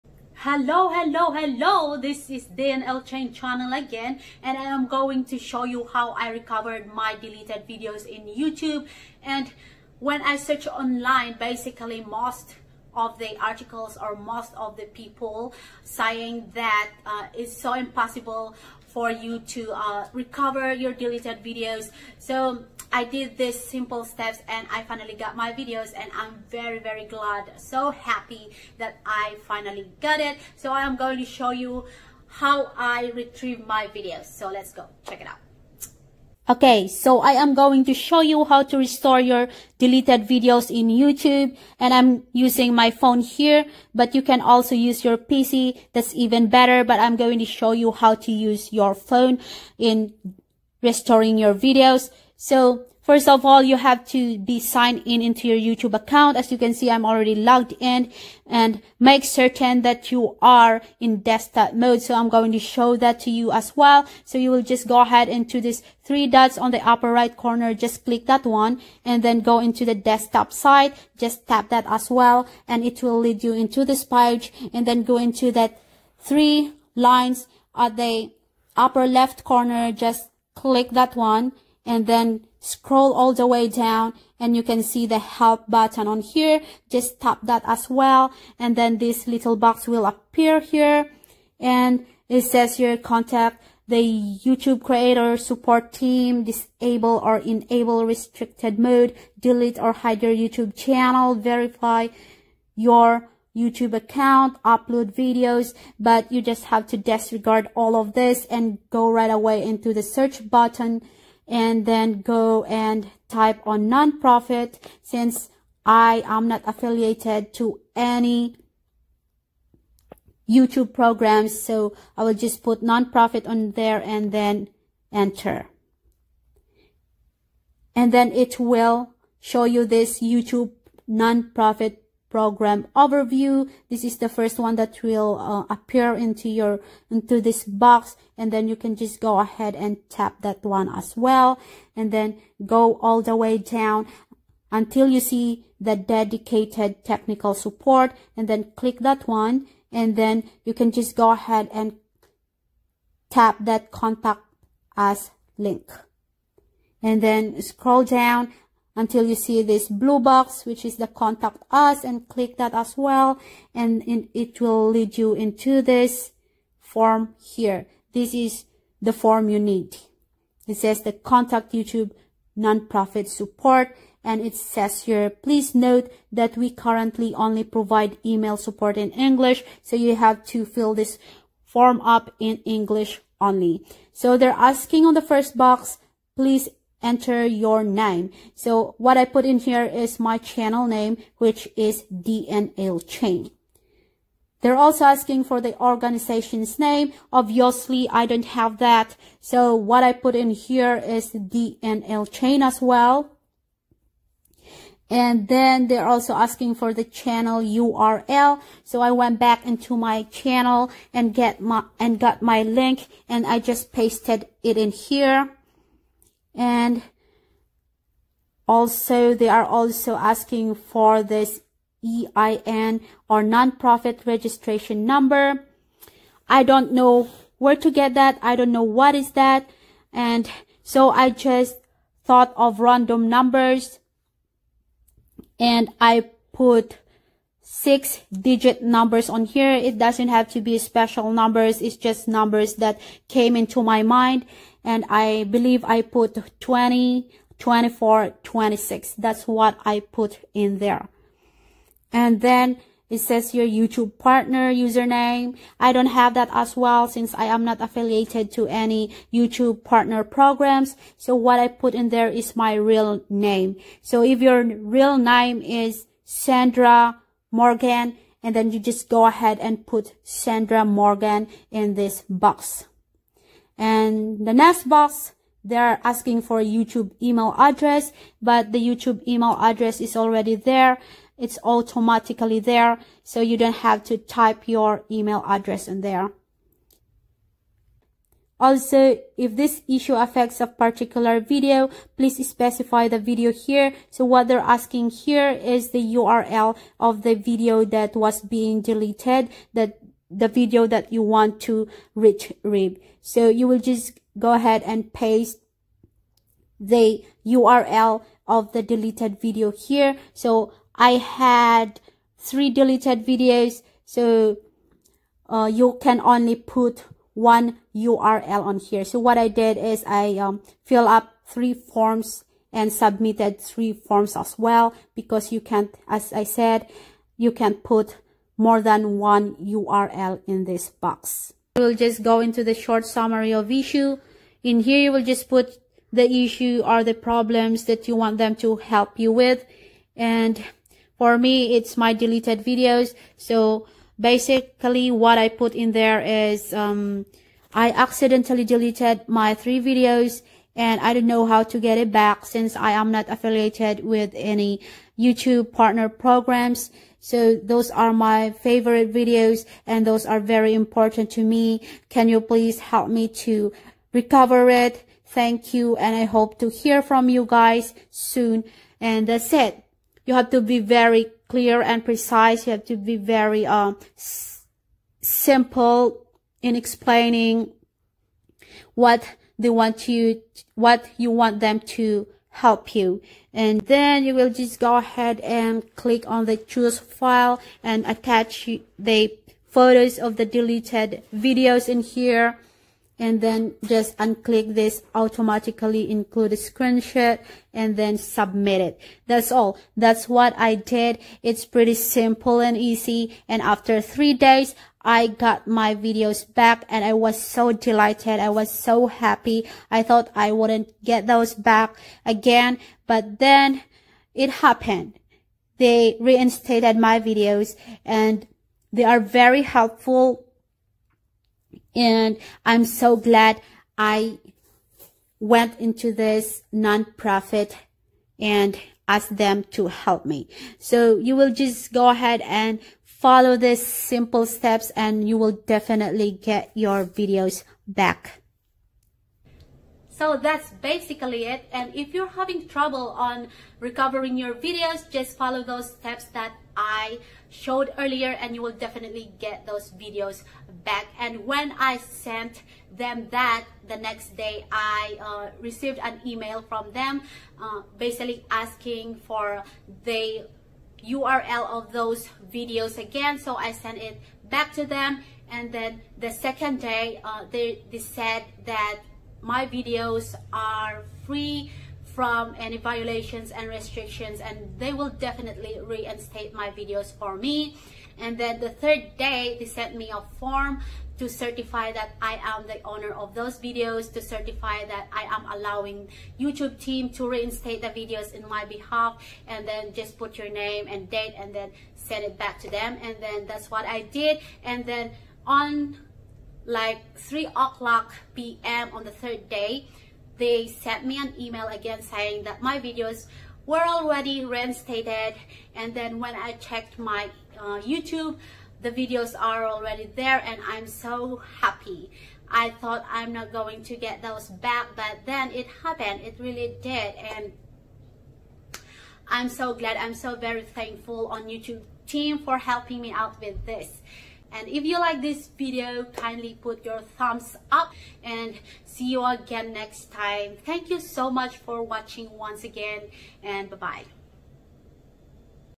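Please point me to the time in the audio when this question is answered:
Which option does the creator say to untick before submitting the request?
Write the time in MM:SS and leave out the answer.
06:35.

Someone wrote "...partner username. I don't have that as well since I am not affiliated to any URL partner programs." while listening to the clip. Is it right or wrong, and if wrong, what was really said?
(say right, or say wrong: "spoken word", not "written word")
wrong: "YouTube", not "URL".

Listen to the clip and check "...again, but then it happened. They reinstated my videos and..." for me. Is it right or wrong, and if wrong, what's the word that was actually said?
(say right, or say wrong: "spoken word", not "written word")
right.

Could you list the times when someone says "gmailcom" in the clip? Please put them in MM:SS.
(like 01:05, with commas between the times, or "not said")
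not said.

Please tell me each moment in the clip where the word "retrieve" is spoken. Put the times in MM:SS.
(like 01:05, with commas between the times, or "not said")
00:33, 05:02.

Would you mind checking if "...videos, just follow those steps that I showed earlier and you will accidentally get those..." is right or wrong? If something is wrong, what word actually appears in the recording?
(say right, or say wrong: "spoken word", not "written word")
wrong: "definitely", not "accidentally".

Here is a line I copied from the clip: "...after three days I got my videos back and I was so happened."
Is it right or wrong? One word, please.
wrong.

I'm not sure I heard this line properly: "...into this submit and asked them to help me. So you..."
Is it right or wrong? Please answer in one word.
wrong.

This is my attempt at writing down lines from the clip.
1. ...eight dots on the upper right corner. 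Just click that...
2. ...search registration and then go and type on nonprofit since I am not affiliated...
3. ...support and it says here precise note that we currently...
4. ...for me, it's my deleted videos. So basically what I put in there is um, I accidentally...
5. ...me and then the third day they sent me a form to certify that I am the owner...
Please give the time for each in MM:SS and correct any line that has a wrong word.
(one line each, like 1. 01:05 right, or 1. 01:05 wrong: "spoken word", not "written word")
1. 01:06 wrong: "three", not "eight"
2. 01:50 wrong: "button", not "registration"
3. 02:53 wrong: "please", not "precise"
4. 05:41 right
5. 07:57 right.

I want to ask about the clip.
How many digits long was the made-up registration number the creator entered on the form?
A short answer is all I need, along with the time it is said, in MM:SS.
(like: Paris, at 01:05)
6, at 03:57.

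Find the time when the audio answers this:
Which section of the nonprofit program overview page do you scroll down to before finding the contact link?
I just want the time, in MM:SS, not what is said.
02:25.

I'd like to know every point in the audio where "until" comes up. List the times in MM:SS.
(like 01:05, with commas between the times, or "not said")
02:24, 02:38.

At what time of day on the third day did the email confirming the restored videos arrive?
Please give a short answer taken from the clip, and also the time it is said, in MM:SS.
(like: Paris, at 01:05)
3 p.m., at 08:17.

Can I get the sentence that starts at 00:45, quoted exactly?
That's even better, but I'm going to show you how to use your phone in restoring your videos.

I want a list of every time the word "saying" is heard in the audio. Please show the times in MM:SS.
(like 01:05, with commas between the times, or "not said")
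00:15, 08:22.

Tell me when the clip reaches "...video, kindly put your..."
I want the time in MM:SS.
08:45.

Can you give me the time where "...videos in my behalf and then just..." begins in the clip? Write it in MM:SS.
08:07.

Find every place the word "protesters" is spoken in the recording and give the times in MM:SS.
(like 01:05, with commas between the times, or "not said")
not said.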